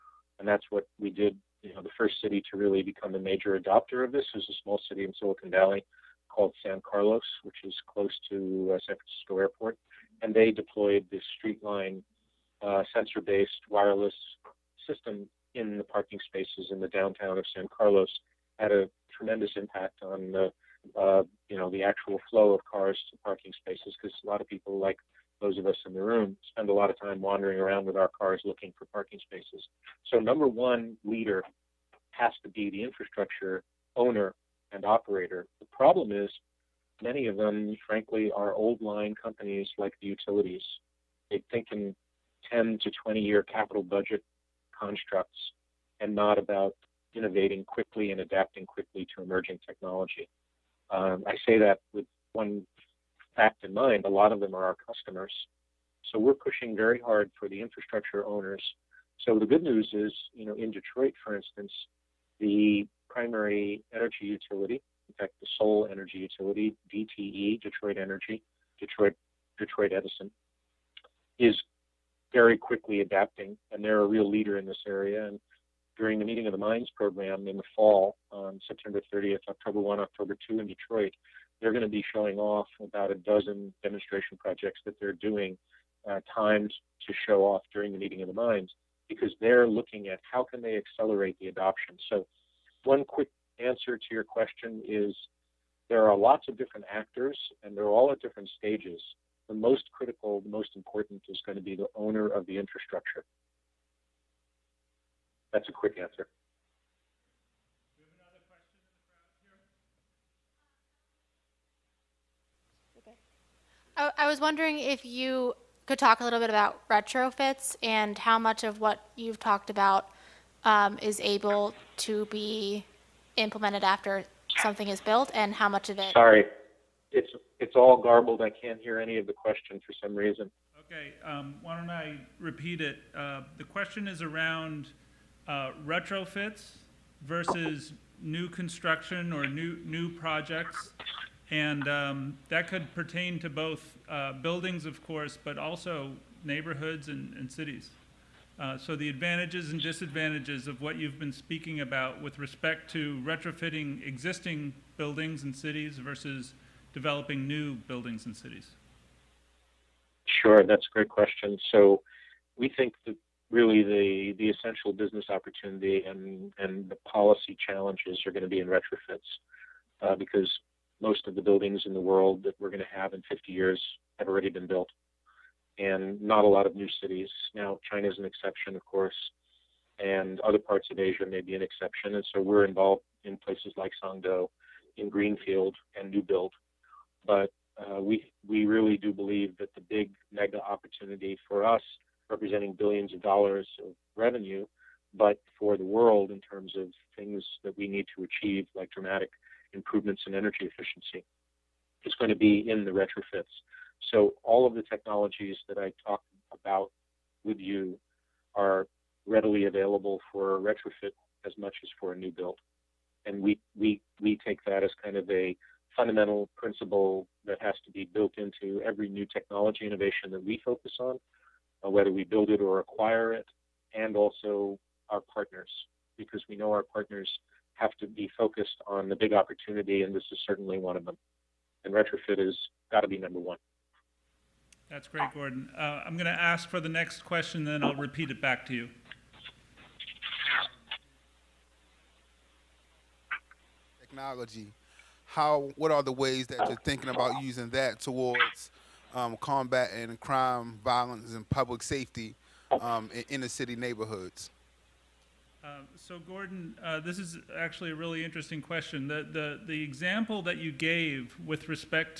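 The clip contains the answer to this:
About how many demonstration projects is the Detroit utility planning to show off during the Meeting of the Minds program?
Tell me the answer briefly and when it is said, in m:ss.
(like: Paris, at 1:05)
12, at 1:23.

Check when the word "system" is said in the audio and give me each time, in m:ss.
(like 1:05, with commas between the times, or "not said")
0:14.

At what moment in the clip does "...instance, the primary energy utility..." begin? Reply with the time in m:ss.
1:01.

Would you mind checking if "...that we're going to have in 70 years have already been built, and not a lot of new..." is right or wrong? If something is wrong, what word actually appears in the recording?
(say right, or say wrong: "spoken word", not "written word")
wrong: "50", not "70".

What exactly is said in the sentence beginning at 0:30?
So, number one leader has to be the infrastructure owner and operator.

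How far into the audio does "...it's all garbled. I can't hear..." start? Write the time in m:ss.
2:07.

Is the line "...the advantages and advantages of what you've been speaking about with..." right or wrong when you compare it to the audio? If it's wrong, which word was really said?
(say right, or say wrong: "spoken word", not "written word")
wrong: "disadvantages", not "advantages".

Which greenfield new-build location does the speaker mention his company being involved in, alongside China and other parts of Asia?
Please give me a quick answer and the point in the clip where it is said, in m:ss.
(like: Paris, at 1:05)
Songdo, at 3:04.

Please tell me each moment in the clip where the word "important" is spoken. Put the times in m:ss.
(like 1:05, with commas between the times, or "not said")
1:40.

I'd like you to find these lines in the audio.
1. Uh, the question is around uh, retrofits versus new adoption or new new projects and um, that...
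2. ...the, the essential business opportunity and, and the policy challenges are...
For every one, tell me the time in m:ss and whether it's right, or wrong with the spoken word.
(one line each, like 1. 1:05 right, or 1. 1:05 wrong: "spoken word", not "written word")
1. 2:13 wrong: "construction", not "adoption"
2. 2:43 right.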